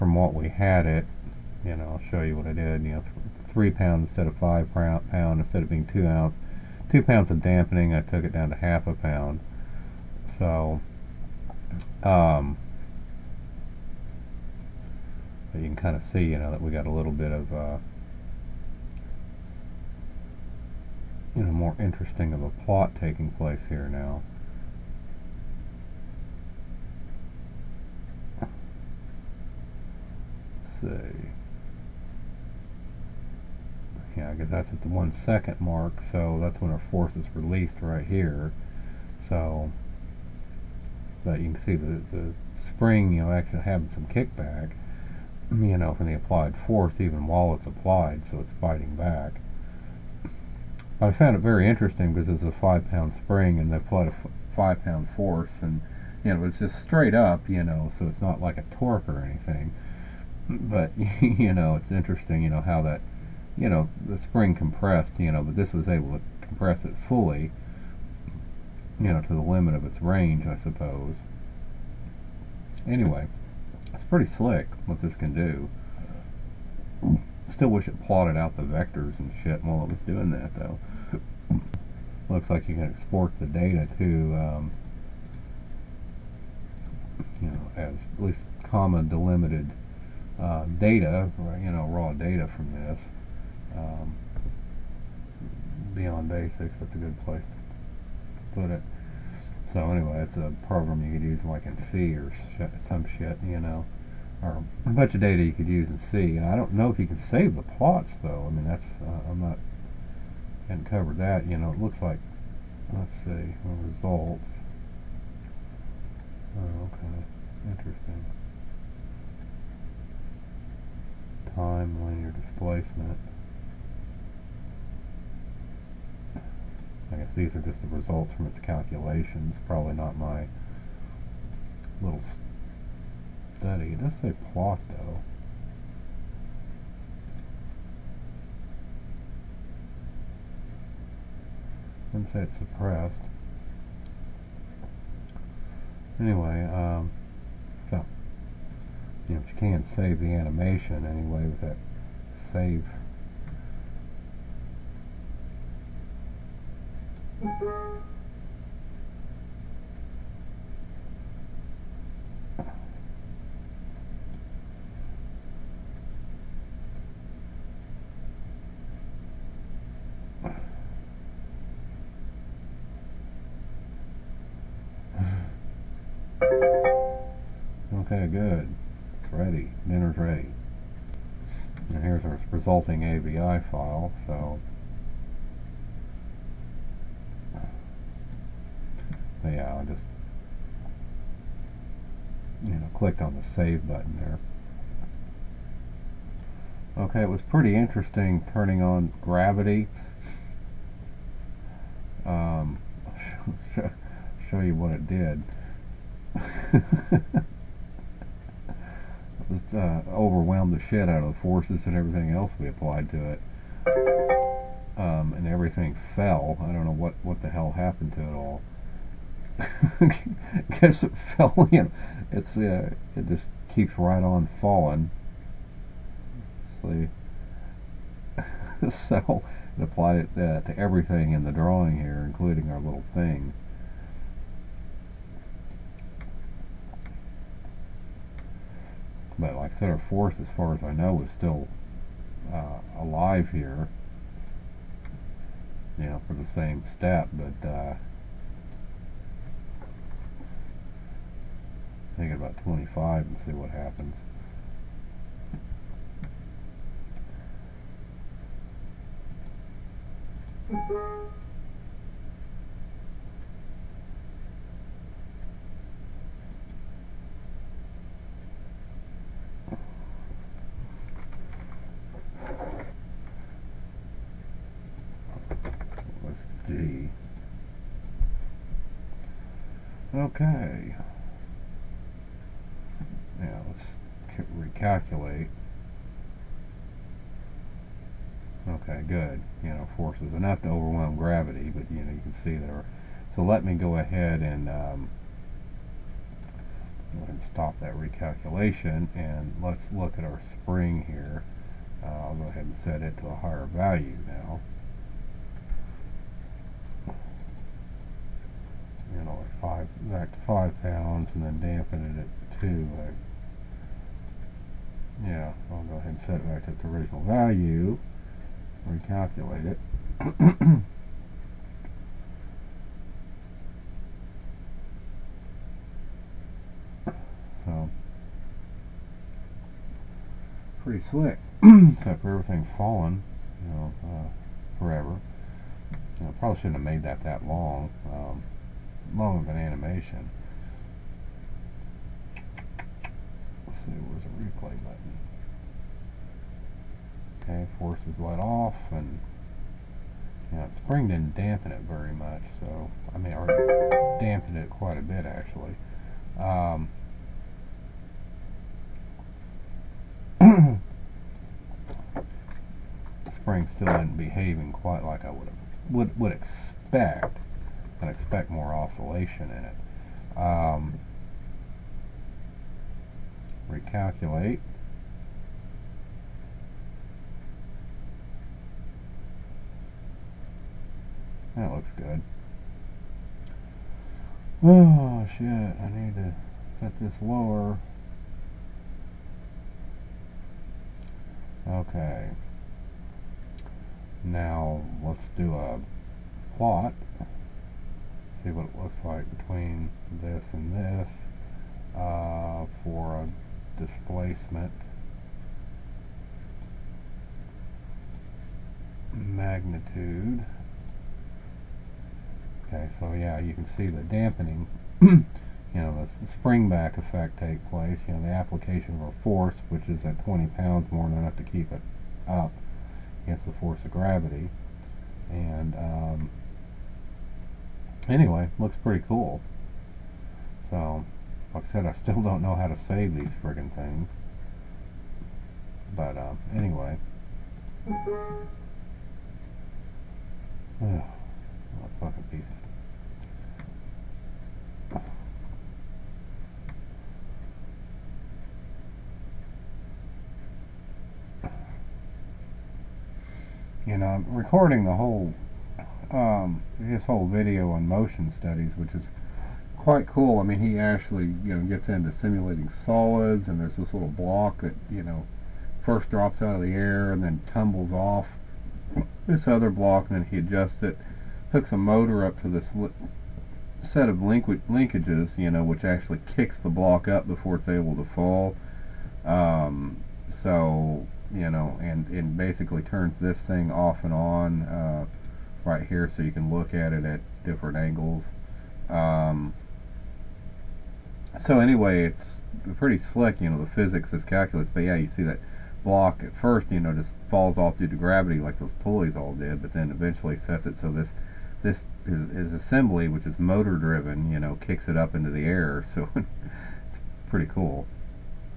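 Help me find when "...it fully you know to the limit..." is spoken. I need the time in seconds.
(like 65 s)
66 s.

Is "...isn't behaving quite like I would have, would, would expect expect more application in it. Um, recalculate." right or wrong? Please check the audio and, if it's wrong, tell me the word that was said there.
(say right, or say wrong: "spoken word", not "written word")
wrong: "oscillation", not "application".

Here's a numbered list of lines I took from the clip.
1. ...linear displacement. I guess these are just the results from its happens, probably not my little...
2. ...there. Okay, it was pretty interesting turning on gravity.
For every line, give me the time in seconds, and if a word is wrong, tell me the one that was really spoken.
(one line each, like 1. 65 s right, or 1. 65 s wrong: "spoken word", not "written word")
1. 122 s wrong: "calculations", not "happens"
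2. 194 s right.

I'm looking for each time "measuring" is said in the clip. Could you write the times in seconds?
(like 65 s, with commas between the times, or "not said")
not said.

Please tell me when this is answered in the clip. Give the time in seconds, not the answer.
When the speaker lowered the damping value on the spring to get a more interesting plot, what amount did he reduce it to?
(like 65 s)
8 s.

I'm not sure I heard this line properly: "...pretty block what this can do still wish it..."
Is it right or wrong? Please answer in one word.
wrong.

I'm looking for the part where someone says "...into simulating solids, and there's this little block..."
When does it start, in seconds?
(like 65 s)
461 s.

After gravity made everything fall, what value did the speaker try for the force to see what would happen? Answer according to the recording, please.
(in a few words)
25.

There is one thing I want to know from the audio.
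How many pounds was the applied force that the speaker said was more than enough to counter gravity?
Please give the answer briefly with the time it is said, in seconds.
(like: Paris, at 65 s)
20, at 420 s.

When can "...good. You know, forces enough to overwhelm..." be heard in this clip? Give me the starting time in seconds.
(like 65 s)
289 s.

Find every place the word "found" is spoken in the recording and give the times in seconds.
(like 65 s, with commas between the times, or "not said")
51 s.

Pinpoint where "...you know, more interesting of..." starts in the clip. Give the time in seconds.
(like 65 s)
21 s.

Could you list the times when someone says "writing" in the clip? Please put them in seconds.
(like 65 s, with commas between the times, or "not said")
not said.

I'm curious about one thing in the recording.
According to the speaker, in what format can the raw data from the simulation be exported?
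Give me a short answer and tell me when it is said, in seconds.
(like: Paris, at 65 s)
comma delimited, at 88 s.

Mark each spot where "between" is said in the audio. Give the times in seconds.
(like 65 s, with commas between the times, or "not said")
399 s.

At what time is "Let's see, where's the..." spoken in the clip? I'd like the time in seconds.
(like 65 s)
342 s.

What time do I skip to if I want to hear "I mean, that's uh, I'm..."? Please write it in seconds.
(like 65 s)
108 s.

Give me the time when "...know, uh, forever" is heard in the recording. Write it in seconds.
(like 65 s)
333 s.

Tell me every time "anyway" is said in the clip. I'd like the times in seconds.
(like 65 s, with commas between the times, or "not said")
72 s, 99 s, 146 s, 151 s, 428 s, 436 s, 491 s.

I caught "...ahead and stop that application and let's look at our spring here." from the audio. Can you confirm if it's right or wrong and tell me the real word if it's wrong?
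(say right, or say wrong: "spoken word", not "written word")
wrong: "recalculation", not "application".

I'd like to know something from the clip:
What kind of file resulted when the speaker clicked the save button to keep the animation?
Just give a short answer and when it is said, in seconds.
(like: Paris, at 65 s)
AVI file, at 183 s.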